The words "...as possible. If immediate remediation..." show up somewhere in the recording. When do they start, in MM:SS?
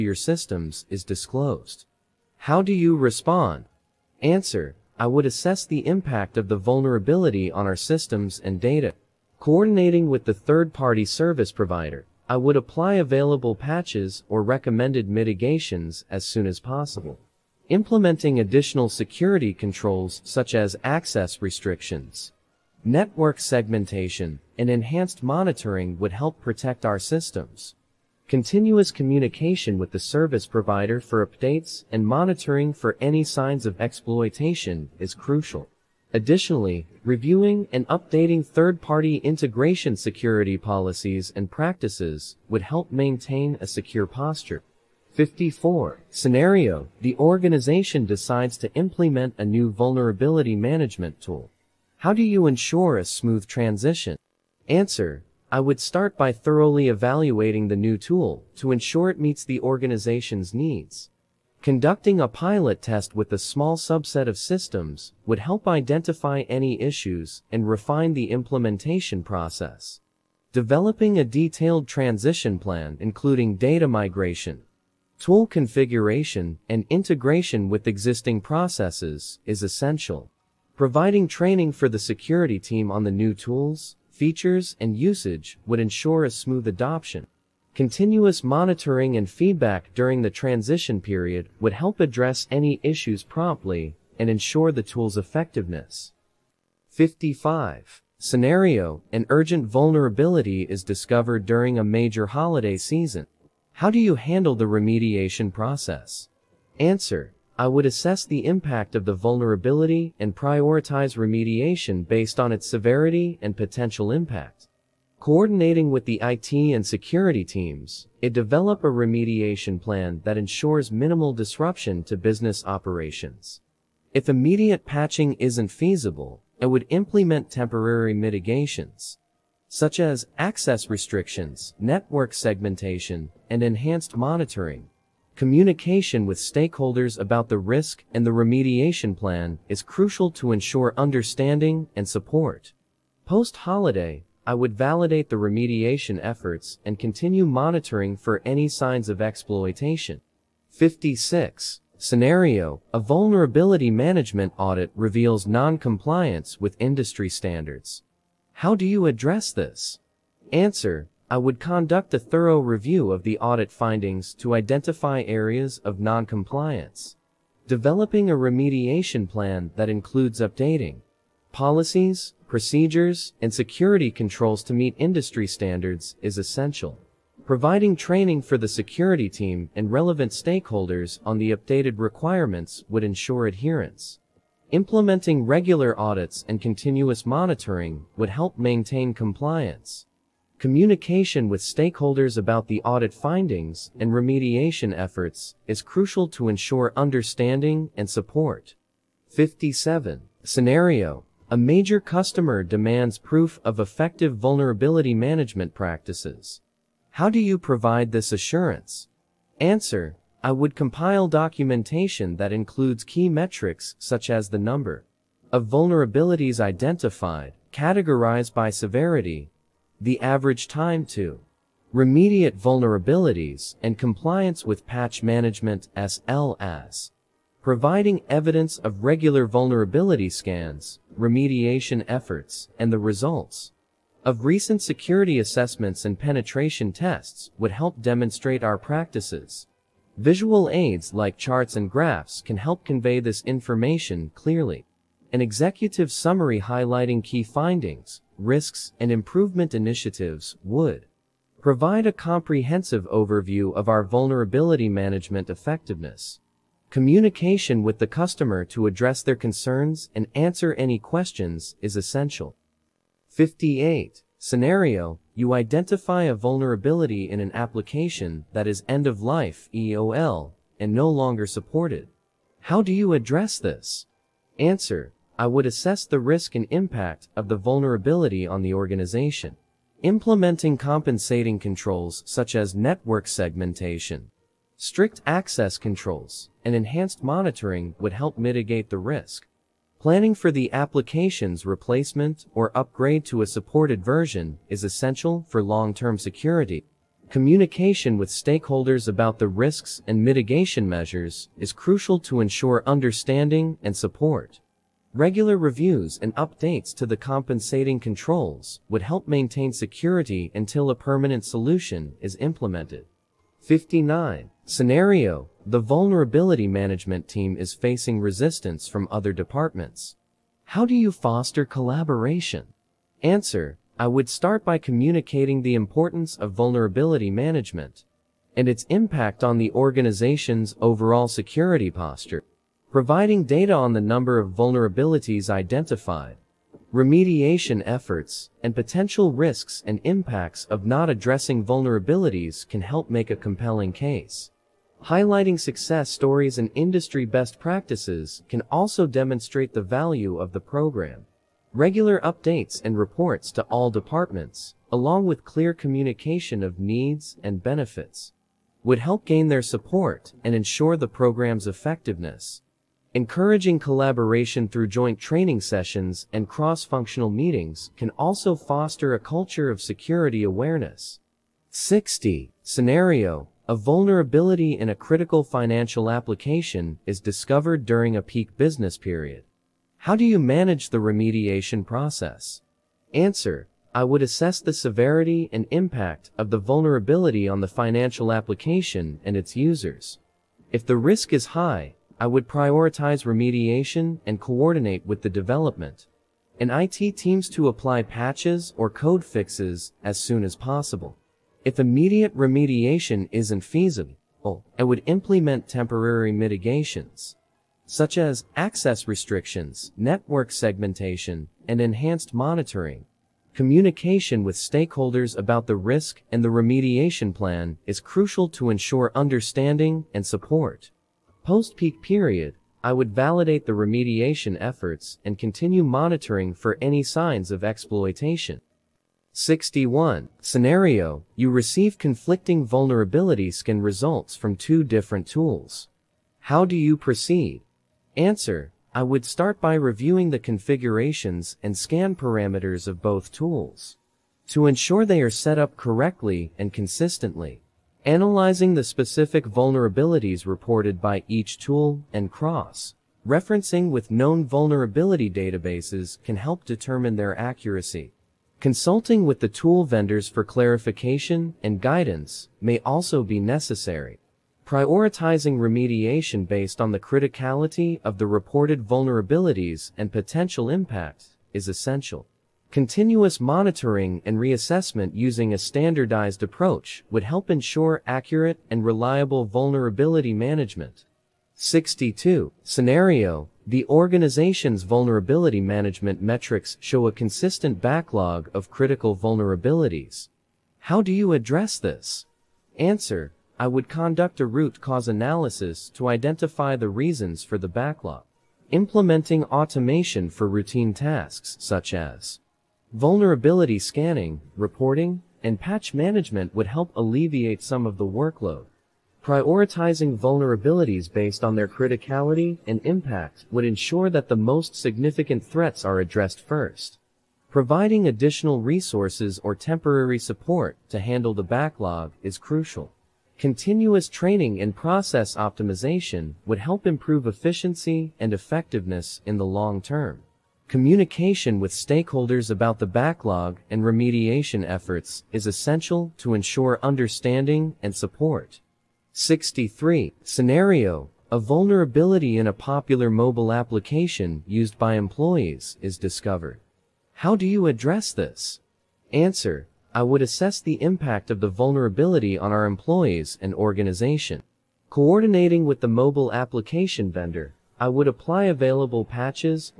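06:40.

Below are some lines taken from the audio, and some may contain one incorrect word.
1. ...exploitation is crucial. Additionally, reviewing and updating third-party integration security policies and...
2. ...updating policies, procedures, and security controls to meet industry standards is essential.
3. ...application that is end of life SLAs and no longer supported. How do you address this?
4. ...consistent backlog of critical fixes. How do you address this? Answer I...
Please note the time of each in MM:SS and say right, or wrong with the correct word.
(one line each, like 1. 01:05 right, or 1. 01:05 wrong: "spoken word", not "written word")
1. 00:33 right
2. 02:50 right
3. 04:27 wrong: "EOL", not "SLAs"
4. 08:07 wrong: "vulnerabilities", not "fixes".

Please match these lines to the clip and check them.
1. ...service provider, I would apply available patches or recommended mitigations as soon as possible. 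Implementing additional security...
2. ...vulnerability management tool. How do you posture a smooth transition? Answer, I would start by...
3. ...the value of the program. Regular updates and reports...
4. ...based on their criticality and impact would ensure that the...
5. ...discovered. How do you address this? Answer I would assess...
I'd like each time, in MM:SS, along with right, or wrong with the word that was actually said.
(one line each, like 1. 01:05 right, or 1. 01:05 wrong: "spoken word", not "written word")
1. 00:11 right
2. 00:49 wrong: "ensure", not "posture"
3. 05:49 right
4. 08:31 right
5. 09:05 right.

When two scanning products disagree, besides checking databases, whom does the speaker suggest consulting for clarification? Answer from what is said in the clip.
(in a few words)
tool vendors.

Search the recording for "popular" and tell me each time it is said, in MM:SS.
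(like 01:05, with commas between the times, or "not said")
09:02.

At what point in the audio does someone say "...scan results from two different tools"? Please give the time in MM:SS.
07:13.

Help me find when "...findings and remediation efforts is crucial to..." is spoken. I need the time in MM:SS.
03:13.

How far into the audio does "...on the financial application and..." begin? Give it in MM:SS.
06:27.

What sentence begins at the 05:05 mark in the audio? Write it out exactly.
Regular reviews and updates to the compensating controls would help maintain security until a permanent solution is implemented.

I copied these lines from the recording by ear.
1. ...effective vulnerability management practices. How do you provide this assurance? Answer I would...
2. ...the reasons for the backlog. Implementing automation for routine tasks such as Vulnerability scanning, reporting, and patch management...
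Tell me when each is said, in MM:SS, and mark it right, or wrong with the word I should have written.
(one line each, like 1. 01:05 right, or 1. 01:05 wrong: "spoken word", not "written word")
1. 03:23 right
2. 08:16 right.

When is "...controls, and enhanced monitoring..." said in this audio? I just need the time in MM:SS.
04:45.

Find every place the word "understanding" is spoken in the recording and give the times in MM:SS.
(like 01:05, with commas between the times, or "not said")
02:20, 03:16, 05:02, 06:59, 08:56.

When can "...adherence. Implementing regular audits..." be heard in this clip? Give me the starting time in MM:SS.
03:03.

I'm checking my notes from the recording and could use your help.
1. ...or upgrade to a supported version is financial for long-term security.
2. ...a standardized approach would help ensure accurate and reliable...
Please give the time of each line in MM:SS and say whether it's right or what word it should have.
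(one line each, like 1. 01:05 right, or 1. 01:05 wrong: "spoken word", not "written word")
1. 04:52 wrong: "essential", not "financial"
2. 07:55 right.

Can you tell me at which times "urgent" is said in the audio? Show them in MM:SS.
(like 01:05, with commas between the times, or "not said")
01:39.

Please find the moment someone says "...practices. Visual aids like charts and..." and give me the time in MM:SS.
03:58.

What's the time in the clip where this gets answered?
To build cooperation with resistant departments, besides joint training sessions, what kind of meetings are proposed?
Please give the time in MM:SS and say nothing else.
06:06.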